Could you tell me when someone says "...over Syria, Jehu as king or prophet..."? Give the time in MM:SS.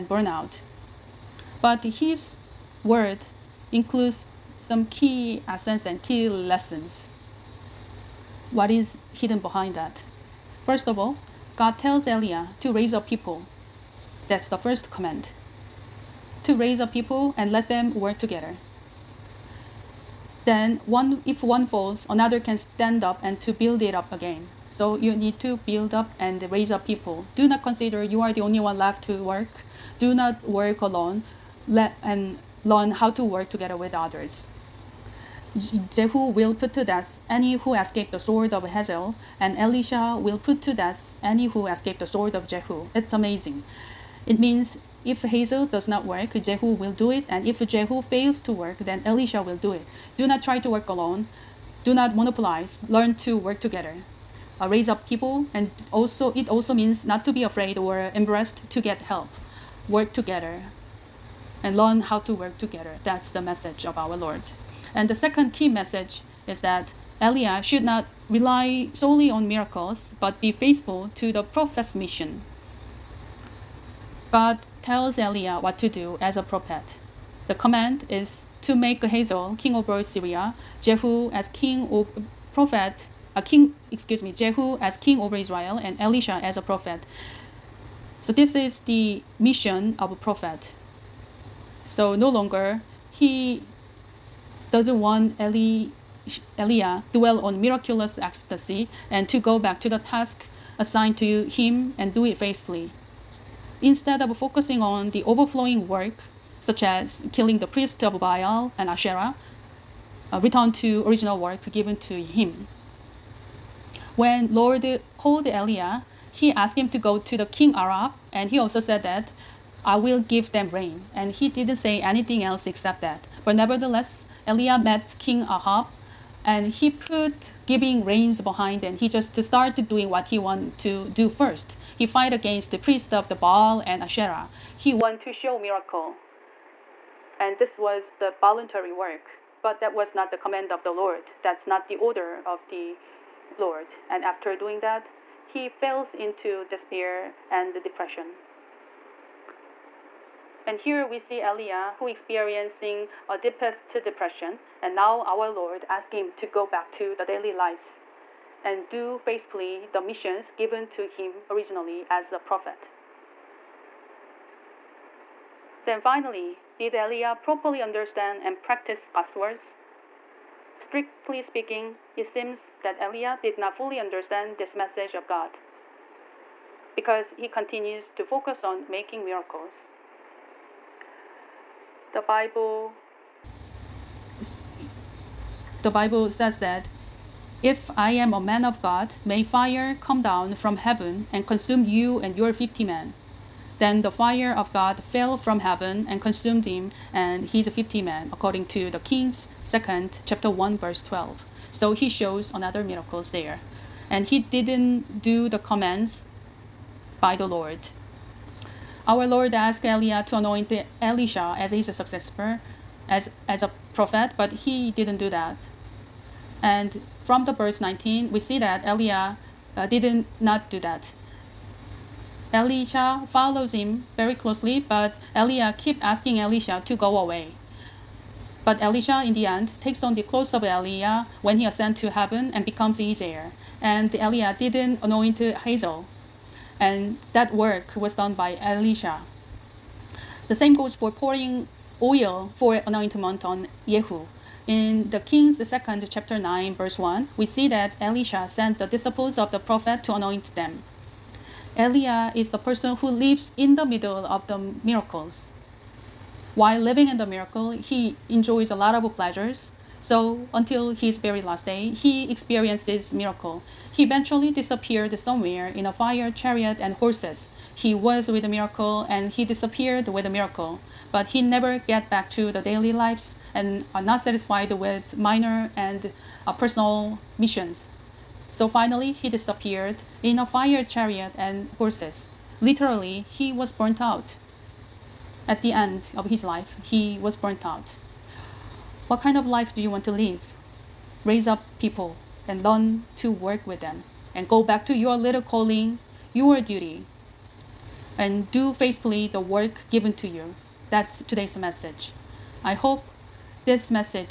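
01:19.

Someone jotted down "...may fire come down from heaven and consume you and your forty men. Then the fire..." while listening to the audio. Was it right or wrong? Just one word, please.
wrong.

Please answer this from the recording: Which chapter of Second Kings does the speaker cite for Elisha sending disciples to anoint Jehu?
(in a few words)
Chapter 9.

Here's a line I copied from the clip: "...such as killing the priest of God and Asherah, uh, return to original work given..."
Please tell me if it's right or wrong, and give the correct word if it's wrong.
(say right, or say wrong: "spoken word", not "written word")
wrong: "Baal", not "God".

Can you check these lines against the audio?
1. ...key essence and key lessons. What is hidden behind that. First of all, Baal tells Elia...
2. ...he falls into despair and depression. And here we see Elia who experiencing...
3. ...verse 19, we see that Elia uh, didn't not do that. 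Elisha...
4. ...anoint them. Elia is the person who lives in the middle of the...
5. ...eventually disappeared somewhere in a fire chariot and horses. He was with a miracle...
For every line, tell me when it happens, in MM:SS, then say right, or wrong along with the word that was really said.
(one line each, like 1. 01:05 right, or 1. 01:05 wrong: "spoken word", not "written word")
1. 00:04 wrong: "God", not "Baal"
2. 02:25 right
3. 03:37 right
4. 04:10 right
5. 04:24 right.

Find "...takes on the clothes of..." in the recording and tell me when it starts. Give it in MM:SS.
03:49.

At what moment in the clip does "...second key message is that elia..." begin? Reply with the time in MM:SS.
01:05.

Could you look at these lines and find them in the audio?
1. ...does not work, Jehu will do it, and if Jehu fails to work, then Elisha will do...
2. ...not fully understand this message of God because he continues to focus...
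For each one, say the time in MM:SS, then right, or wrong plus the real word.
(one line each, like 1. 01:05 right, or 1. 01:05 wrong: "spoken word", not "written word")
1. 00:45 right
2. 02:53 right.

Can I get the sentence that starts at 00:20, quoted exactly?
Then one if one falls, another can stand up and to build it up again.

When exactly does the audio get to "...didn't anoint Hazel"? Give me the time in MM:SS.
03:54.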